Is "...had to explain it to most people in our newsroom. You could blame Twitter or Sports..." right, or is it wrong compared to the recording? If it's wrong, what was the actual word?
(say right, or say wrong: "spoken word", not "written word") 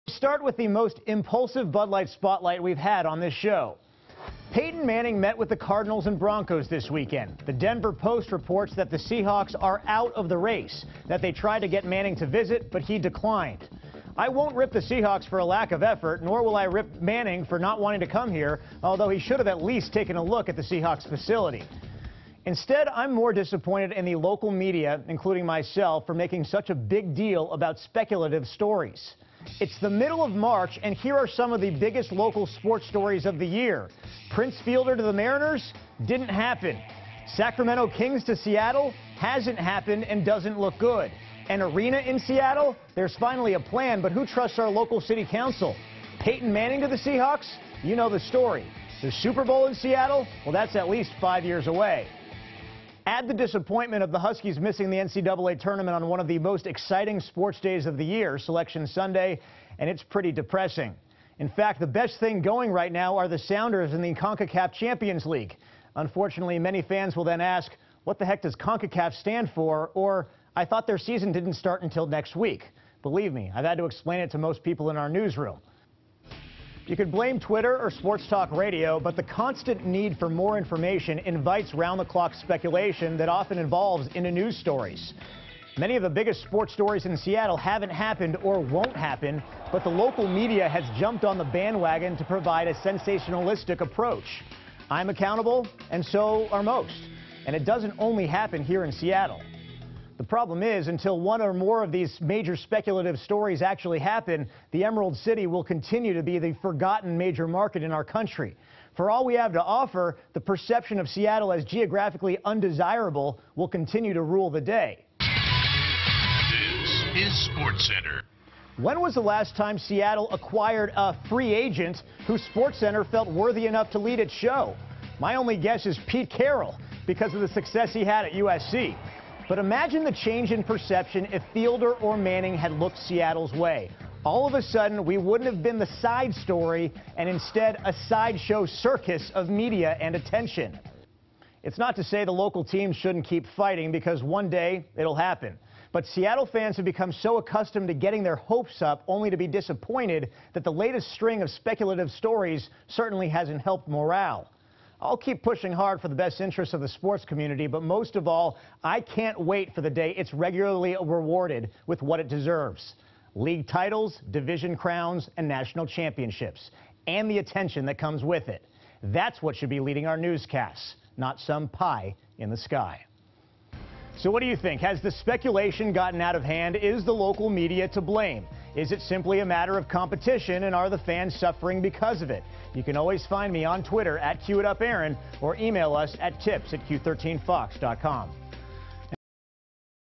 right.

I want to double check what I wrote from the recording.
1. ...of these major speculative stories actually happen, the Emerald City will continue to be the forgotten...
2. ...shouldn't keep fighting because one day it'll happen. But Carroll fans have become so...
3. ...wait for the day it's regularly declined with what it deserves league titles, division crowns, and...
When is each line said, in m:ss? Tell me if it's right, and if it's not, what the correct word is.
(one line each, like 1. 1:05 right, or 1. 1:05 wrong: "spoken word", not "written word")
1. 1:41 right
2. 2:22 wrong: "Seattle", not "Carroll"
3. 2:39 wrong: "rewarded", not "declined".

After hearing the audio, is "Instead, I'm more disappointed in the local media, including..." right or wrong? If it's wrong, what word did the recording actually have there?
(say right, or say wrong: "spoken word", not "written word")
right.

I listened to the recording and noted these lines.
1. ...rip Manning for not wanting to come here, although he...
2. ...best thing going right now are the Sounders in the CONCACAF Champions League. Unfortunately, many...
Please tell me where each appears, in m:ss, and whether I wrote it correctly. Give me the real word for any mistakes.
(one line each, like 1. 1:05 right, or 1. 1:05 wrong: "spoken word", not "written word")
1. 0:16 right
2. 1:01 right.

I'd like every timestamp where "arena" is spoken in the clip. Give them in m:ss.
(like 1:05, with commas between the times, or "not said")
0:41.